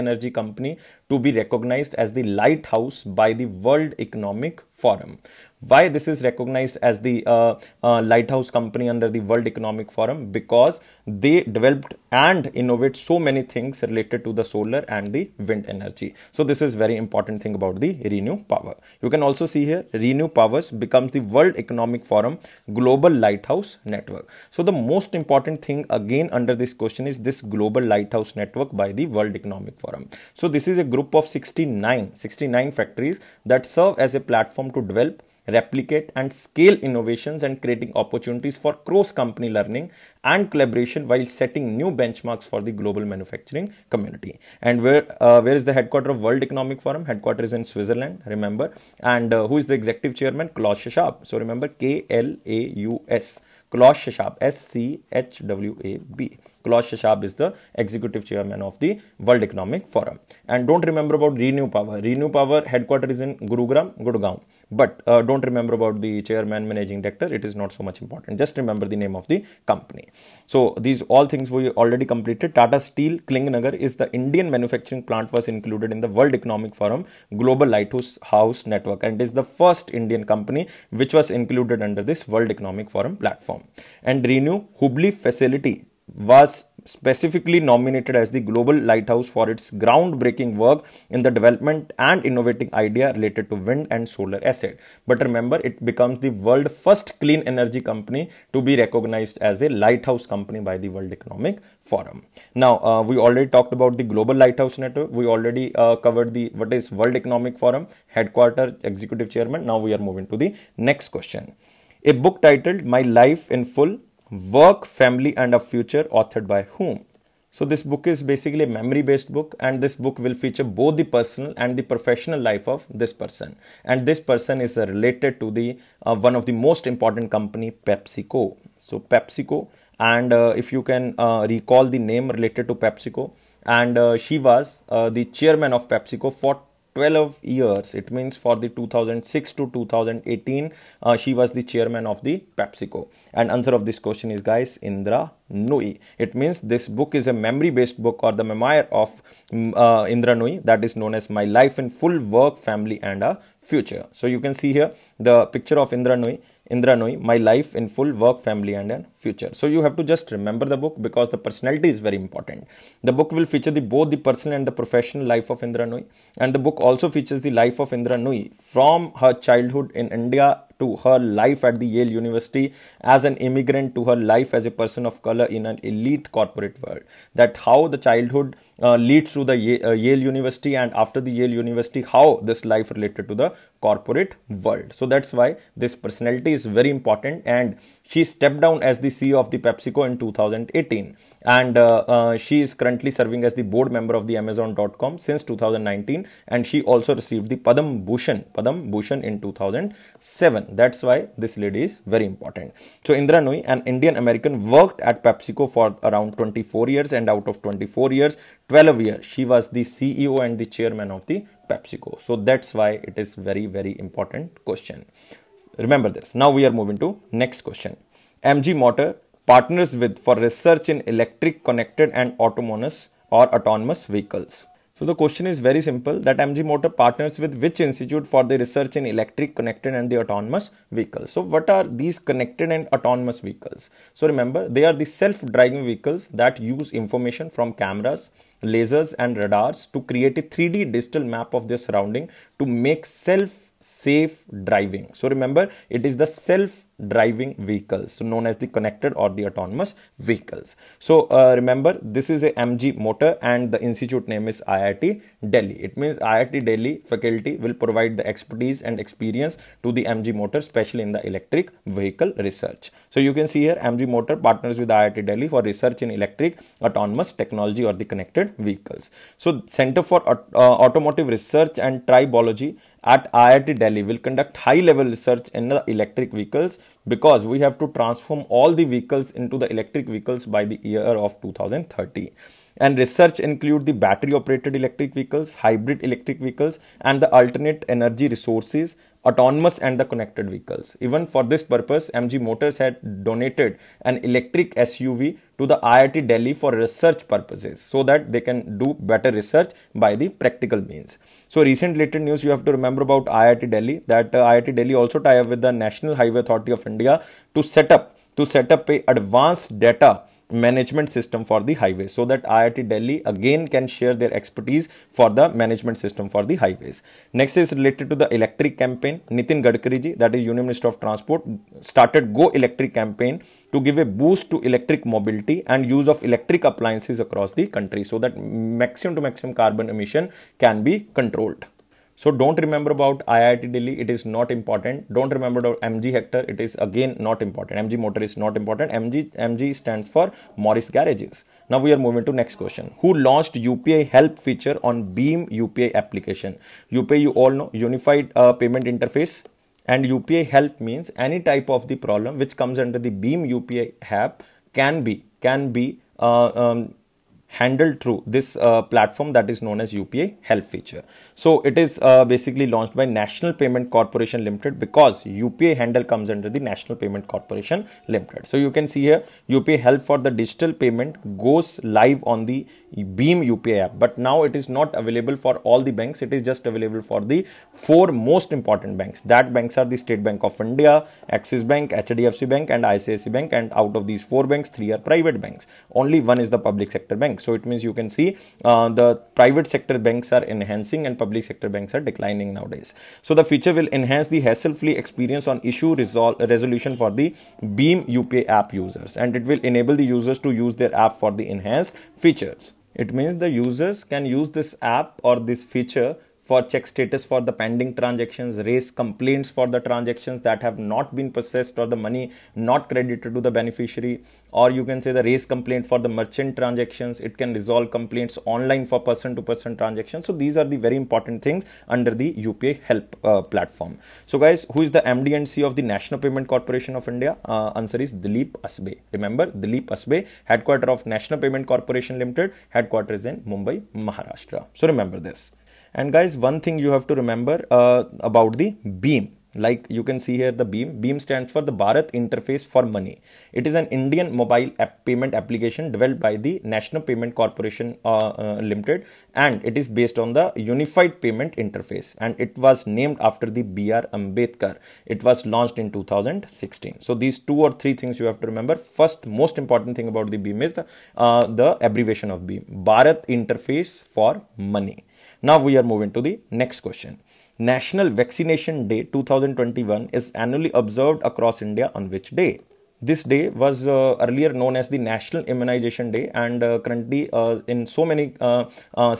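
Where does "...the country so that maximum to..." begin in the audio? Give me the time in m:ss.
5:27.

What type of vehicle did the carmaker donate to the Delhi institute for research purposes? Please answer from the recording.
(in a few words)
Electric SUV.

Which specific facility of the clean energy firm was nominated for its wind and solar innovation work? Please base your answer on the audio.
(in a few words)
Hubli.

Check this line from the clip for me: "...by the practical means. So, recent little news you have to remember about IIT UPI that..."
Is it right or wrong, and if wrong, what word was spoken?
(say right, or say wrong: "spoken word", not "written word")
wrong: "Delhi", not "UPI".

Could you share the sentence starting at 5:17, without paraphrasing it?
Next is related to the electric campaign.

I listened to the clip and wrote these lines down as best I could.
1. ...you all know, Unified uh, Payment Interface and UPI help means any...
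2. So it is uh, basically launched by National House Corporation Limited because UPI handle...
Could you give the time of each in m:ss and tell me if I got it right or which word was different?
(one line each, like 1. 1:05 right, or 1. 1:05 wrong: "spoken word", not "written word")
1. 5:47 right
2. 6:01 wrong: "Payment", not "House".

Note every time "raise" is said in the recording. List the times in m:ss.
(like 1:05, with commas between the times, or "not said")
6:48, 6:55.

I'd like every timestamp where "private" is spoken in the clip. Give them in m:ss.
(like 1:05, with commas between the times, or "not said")
6:24, 6:29.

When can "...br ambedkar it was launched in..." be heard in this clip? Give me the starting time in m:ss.
7:33.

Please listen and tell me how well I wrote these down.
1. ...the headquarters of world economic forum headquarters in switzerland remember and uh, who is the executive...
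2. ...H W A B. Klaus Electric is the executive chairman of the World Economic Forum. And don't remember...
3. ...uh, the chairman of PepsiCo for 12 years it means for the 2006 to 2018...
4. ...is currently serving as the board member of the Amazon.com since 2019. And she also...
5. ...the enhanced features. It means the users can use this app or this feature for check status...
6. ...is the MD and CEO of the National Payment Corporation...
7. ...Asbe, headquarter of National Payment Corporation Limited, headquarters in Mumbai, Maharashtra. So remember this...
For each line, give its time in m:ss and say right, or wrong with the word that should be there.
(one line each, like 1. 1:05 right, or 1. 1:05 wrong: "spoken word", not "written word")
1. 0:45 right
2. 0:55 wrong: "Schwab", not "Electric"
3. 2:14 right
4. 3:12 right
5. 6:41 right
6. 7:04 right
7. 7:09 right.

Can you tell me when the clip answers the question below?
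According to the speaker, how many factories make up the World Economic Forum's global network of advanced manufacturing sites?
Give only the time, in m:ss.
0:32.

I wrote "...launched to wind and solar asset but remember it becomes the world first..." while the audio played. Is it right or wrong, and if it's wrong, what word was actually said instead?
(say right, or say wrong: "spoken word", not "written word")
wrong: "related", not "launched".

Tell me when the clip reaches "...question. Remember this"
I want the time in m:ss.
3:34.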